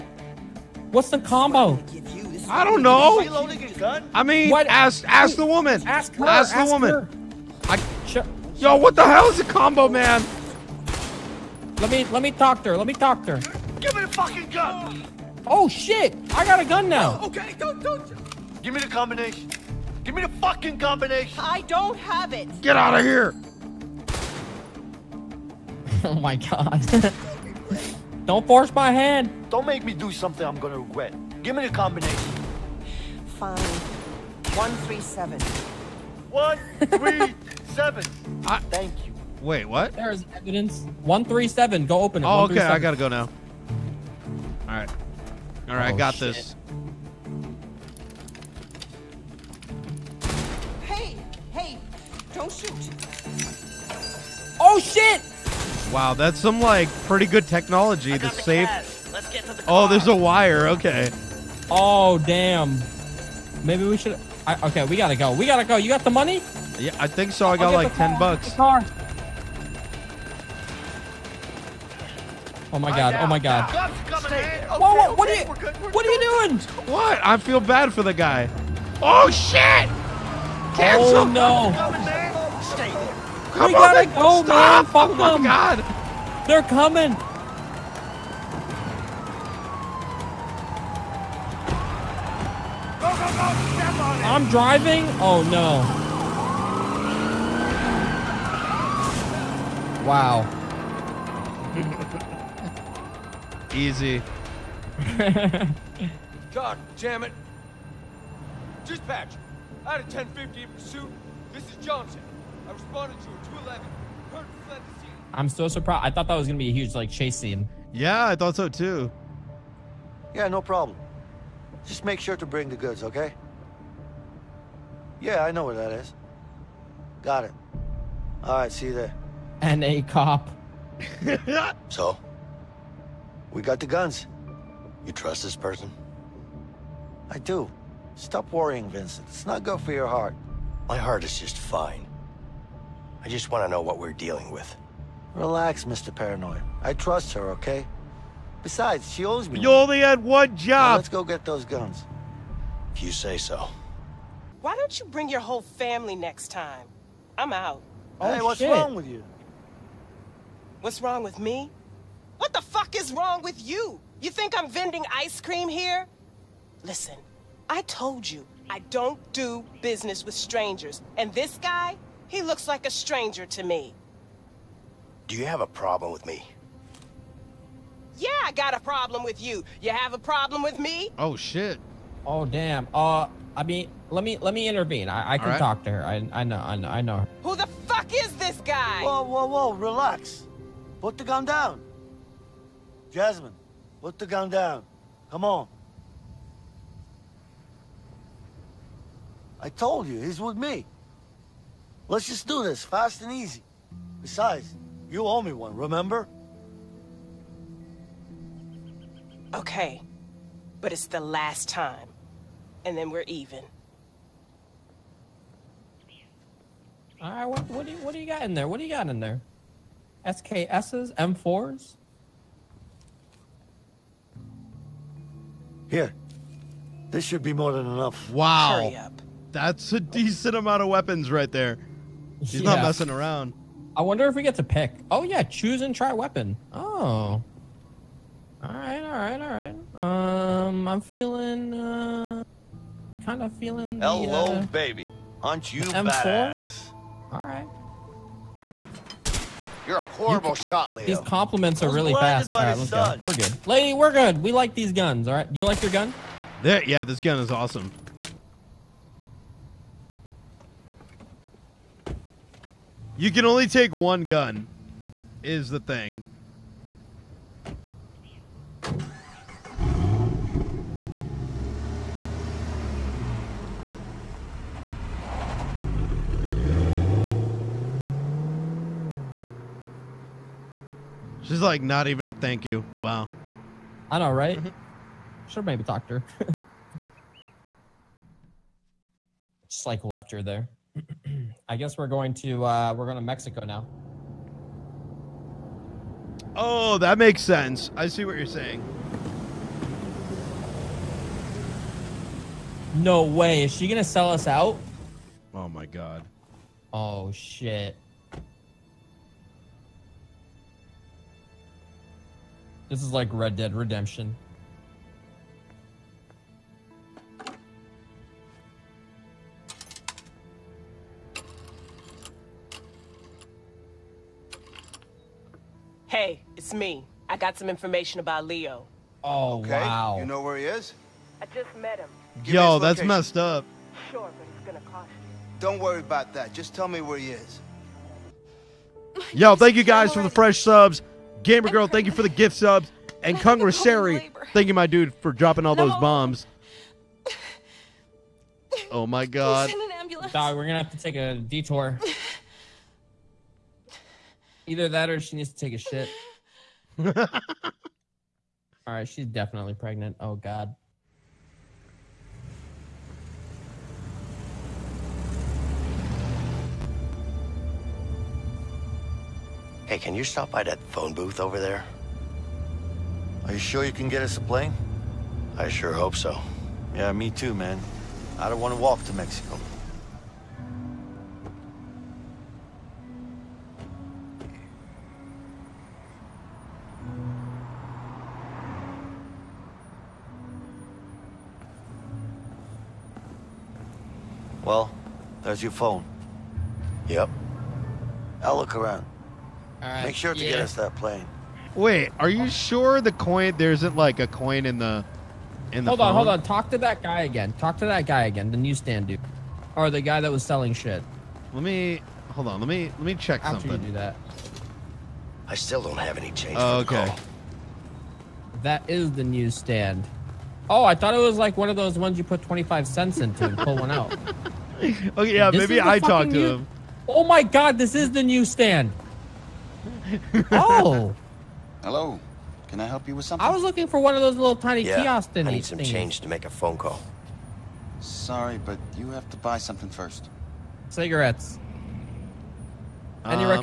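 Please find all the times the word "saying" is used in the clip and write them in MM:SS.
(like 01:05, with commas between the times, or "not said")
04:58.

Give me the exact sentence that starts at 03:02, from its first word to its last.
Uh, I mean, let me let me intervene.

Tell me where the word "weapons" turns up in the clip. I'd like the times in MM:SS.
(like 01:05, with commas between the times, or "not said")
03:50, 03:56.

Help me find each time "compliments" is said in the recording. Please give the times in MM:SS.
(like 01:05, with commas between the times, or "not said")
04:11.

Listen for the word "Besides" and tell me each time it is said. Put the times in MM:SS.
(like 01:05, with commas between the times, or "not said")
02:28, 03:24.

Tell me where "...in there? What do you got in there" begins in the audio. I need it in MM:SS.
03:38.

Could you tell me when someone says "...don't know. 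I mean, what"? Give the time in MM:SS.
00:02.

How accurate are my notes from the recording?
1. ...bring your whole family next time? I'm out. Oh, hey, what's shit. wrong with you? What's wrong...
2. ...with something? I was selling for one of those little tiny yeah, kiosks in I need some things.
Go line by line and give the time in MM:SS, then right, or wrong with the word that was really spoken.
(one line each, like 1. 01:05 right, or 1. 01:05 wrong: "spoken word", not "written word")
1. 02:35 right
2. 07:13 wrong: "looking", not "selling".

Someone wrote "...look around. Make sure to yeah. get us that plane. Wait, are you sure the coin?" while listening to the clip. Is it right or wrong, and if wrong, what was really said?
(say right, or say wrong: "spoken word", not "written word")
right.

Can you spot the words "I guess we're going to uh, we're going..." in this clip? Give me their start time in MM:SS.
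04:51.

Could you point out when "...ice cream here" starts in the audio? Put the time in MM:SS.
02:45.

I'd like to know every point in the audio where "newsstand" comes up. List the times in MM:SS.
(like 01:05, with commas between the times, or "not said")
06:48, 06:59.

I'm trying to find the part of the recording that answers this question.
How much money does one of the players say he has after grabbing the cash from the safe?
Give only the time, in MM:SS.
01:07.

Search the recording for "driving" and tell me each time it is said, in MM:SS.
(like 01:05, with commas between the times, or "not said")
01:34.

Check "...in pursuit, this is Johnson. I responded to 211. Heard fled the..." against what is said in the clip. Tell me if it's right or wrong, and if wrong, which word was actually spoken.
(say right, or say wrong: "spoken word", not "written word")
right.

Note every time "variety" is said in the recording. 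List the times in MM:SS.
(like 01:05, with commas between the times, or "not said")
not said.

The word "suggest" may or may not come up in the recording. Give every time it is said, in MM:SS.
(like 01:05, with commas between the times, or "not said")
not said.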